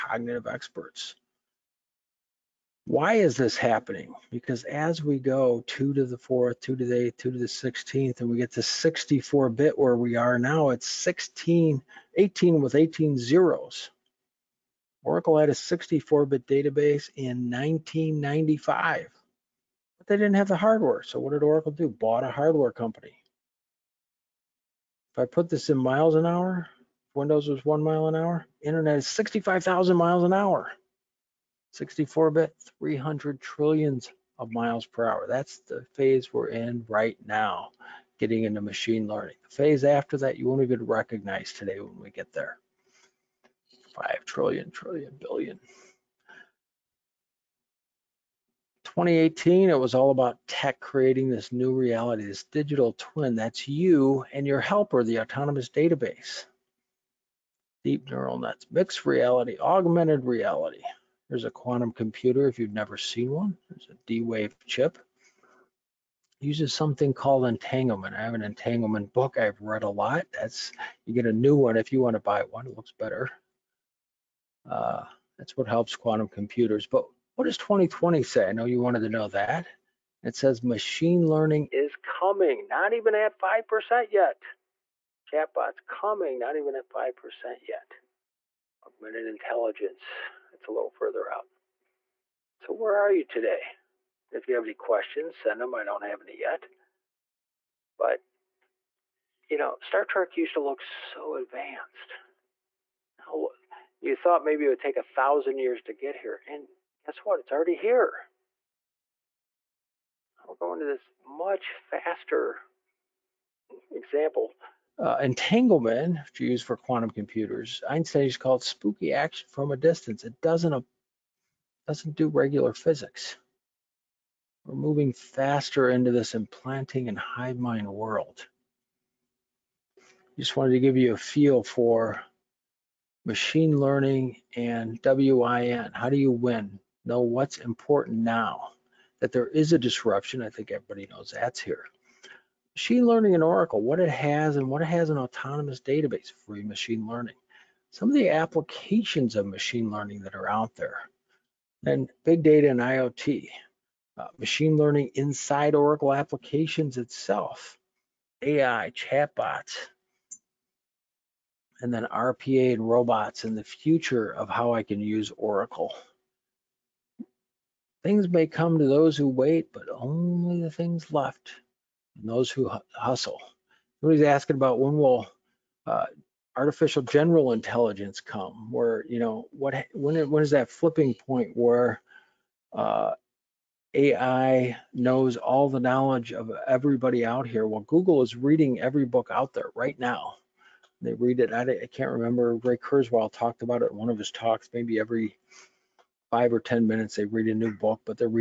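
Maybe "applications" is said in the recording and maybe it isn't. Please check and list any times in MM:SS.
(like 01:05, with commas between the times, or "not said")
02:28, 02:36.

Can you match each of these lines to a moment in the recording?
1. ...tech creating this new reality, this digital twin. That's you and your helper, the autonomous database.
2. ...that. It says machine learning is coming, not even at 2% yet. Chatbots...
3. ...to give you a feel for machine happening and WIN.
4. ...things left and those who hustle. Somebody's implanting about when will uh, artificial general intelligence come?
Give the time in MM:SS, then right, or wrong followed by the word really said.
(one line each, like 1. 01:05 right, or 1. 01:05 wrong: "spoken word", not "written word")
1. 00:50 right
2. 01:19 wrong: "5", not "2"
3. 02:10 wrong: "learning", not "happening"
4. 02:50 wrong: "asking", not "implanting".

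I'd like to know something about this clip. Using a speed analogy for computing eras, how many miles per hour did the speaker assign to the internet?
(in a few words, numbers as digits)
65,000 miles an hour.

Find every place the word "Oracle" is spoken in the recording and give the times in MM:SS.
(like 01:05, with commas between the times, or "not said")
00:15, 00:21, 02:23, 02:35, 02:45.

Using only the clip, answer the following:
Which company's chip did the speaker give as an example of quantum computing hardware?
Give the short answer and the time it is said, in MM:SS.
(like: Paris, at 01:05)
D-Wave, at 01:04.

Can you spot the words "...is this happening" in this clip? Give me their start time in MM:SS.
00:03.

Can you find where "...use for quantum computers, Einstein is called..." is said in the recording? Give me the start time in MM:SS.
01:56.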